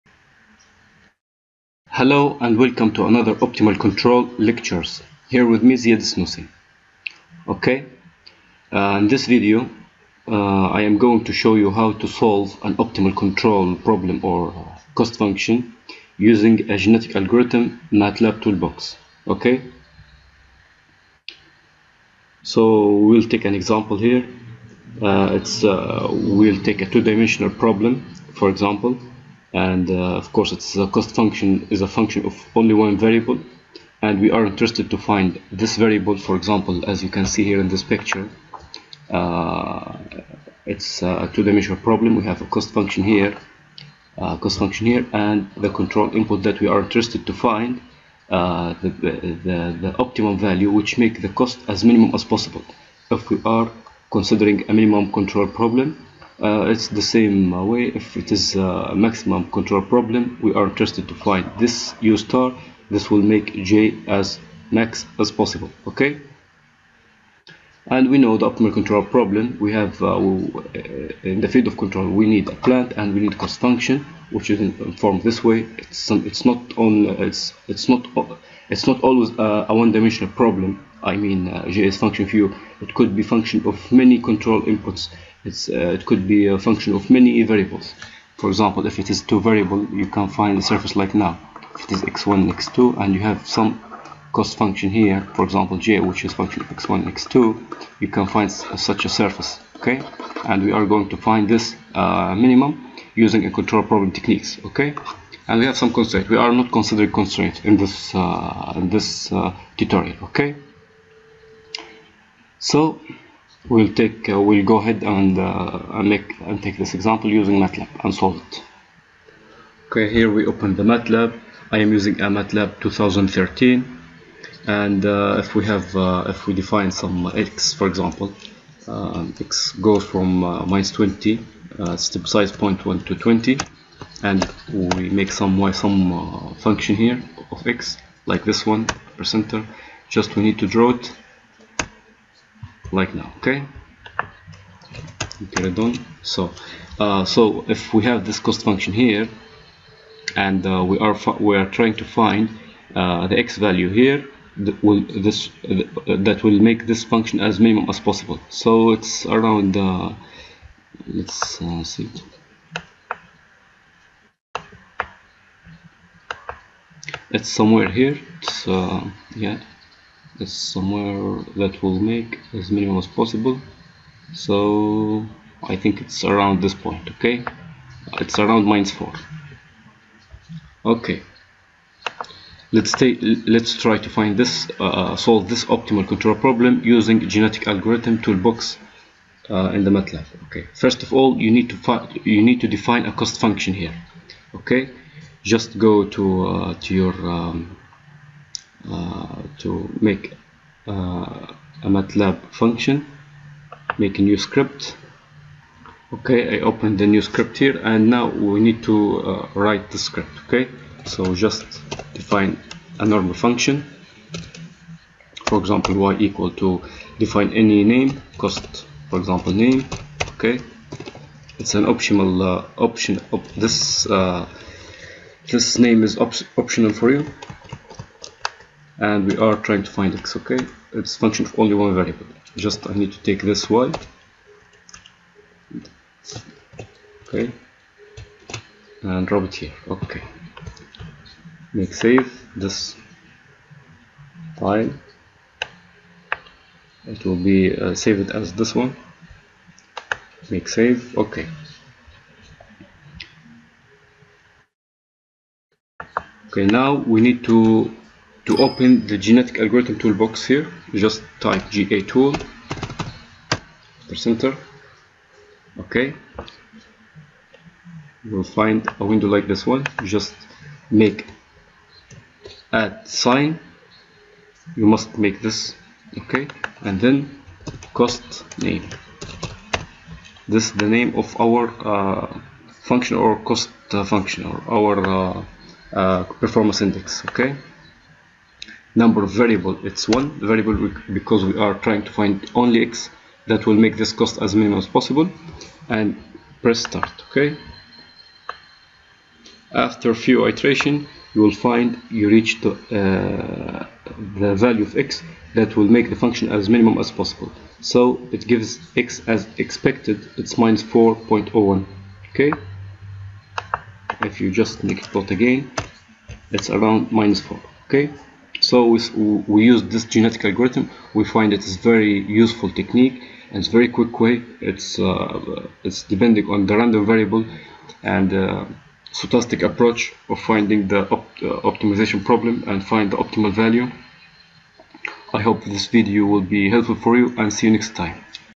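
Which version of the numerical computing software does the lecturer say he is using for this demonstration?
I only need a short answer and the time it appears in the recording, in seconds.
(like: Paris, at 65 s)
MATLAB 2013, at 122 s.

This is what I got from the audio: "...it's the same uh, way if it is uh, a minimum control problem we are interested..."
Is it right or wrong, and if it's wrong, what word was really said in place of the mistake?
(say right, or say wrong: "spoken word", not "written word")
wrong: "maximum", not "minimum".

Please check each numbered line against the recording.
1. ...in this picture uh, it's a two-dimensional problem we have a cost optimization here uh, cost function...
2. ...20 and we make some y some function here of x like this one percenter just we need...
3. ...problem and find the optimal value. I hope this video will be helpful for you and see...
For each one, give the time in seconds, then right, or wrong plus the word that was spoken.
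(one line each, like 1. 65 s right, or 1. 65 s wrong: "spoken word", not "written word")
1. 37 s wrong: "function", not "optimization"
2. 133 s right
3. 332 s right.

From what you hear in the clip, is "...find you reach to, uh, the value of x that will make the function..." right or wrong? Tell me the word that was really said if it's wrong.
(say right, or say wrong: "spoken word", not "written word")
right.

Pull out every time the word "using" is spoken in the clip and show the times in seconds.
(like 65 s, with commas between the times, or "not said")
16 s, 103 s, 117 s, 121 s, 186 s.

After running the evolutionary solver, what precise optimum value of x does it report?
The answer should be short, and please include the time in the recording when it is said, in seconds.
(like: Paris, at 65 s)
-4.01, at 310 s.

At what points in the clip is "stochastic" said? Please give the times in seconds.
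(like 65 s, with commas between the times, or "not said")
329 s.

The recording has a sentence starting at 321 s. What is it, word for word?
We find it is very useful technique and it's very quick way.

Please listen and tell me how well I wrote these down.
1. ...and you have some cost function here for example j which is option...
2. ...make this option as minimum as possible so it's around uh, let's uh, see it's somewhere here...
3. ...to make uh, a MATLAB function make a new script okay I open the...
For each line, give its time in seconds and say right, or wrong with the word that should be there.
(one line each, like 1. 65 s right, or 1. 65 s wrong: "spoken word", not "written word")
1. 93 s wrong: "function", not "option"
2. 156 s wrong: "function", not "option"
3. 199 s right.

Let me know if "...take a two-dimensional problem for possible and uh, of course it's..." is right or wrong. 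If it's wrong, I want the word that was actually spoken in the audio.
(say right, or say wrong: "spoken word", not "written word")
wrong: "example", not "possible".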